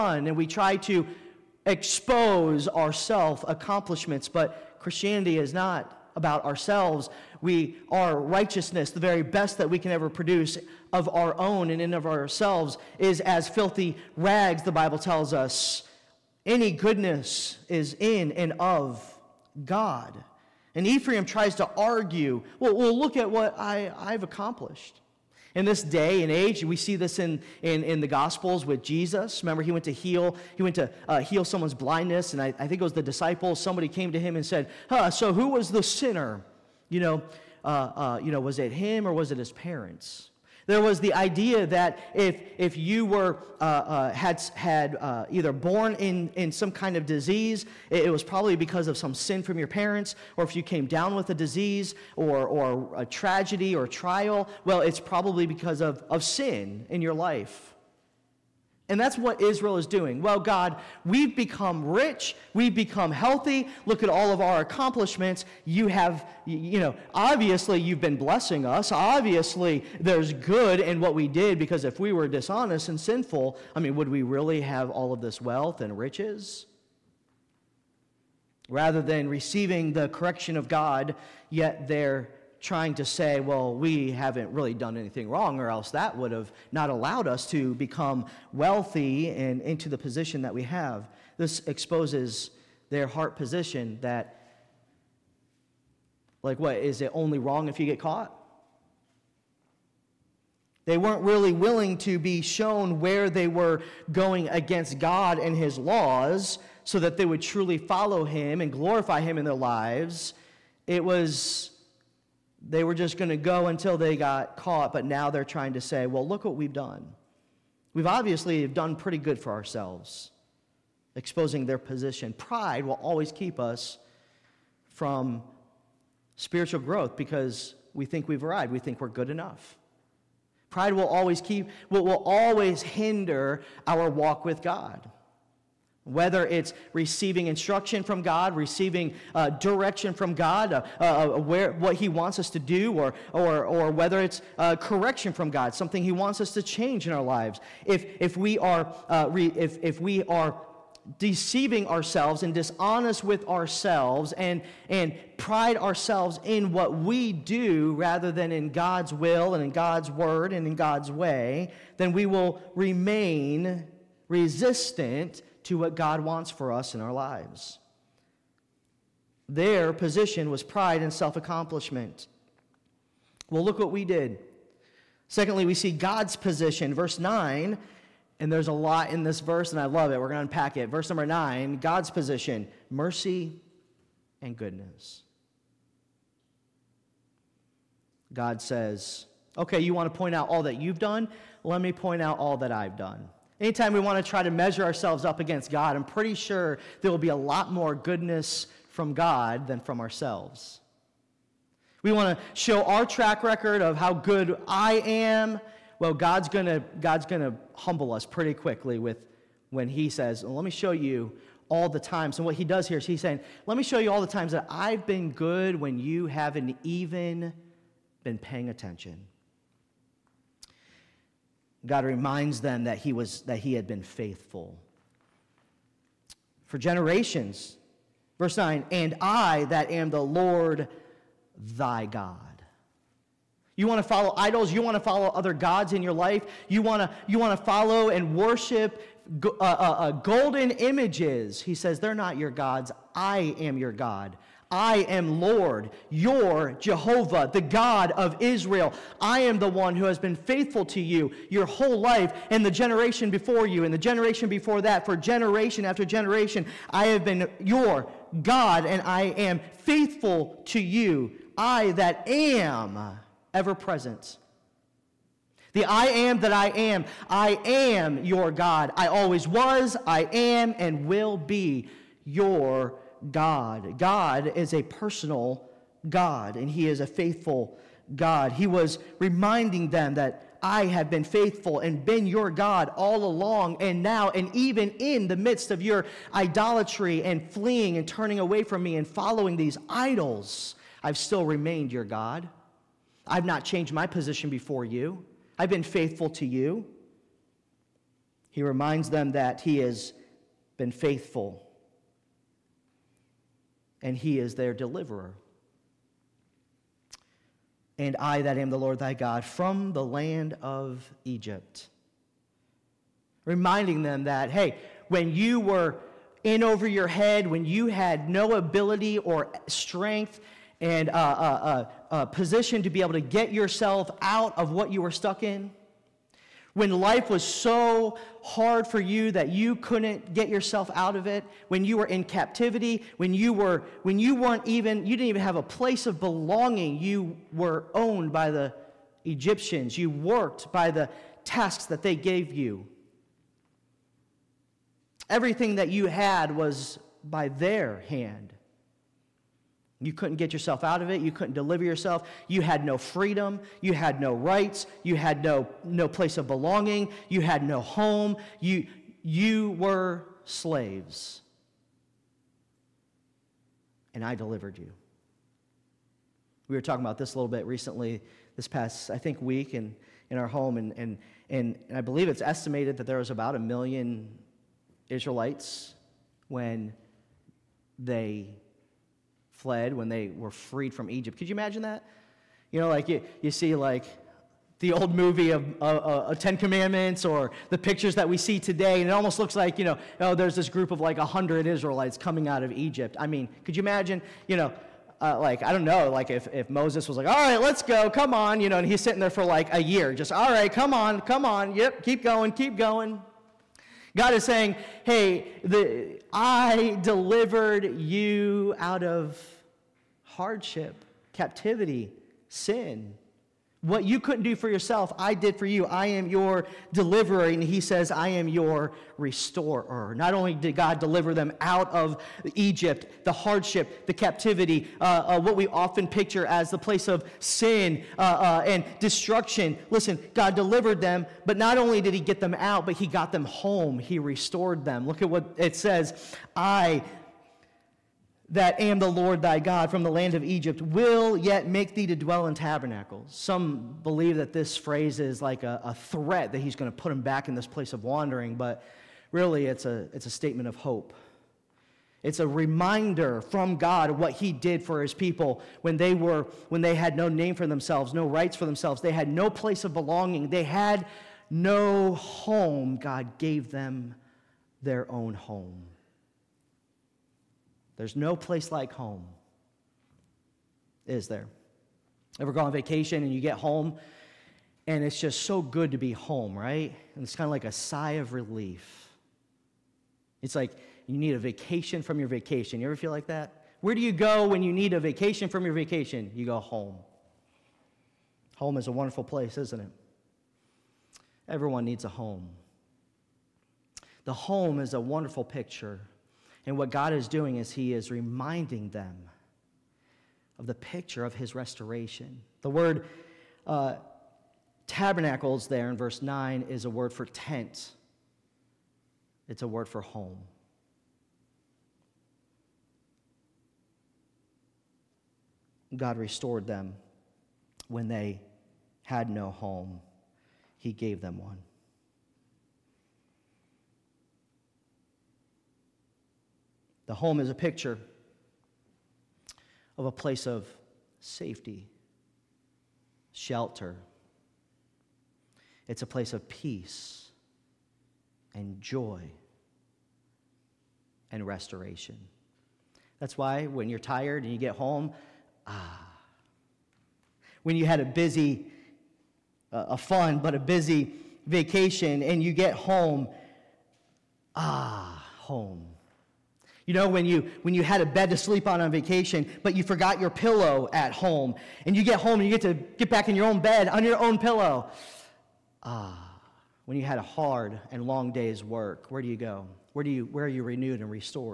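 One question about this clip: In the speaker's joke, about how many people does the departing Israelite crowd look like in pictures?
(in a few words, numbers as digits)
100.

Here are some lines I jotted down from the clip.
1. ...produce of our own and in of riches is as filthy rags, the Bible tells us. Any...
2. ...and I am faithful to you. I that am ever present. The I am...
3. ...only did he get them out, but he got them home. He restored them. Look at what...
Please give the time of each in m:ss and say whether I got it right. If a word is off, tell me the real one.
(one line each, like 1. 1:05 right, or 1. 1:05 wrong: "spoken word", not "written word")
1. 0:10 wrong: "ourselves", not "riches"
2. 4:18 right
3. 7:11 right.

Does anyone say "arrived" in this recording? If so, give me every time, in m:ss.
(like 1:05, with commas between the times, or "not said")
2:08.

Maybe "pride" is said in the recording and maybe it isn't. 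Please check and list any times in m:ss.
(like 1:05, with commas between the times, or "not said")
2:02, 2:10, 2:35, 2:50.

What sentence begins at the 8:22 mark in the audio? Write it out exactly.
The word uh, tabernacles there in verse 9 is a word for tent, it's a word for home.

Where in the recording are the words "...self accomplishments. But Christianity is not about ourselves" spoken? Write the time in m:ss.
0:02.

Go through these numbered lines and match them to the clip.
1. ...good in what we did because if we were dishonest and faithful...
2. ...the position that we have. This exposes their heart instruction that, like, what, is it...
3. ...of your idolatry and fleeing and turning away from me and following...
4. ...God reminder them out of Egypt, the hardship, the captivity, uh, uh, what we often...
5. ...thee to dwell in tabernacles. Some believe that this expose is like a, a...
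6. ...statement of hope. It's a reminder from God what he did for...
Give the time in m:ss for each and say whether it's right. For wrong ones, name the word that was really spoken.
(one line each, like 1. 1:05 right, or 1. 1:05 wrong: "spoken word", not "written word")
1. 1:10 wrong: "sinful", not "faithful"
2. 1:29 wrong: "position", not "instruction"
3. 4:45 right
4. 7:00 wrong: "deliver", not "reminder"
5. 7:21 wrong: "phrase", not "expose"
6. 7:30 right.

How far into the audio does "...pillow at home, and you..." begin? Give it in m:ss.
9:20.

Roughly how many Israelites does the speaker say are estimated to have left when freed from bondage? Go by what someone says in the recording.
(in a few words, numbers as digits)
About a million.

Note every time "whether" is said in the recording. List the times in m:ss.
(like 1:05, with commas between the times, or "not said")
2:16, 2:23.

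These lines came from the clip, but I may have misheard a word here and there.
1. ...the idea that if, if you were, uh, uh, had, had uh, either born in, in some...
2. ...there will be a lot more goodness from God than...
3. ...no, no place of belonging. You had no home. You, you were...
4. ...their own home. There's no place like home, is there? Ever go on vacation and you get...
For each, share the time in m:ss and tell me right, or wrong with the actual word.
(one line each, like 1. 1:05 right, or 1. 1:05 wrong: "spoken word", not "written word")
1. 0:40 right
2. 3:17 right
3. 5:55 right
4. 7:44 right.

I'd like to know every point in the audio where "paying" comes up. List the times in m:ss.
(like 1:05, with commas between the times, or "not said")
3:38.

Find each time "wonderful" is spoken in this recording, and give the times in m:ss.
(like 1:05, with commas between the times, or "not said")
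8:08, 8:15.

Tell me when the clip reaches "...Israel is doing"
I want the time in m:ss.
0:59.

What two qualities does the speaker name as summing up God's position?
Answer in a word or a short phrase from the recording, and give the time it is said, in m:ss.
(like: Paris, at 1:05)
Mercy and goodness, at 3:02.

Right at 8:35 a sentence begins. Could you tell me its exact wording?
God restored them when they had no home, He gave them one.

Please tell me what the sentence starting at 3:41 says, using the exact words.
God reminds them that he, was, that he had been faithful.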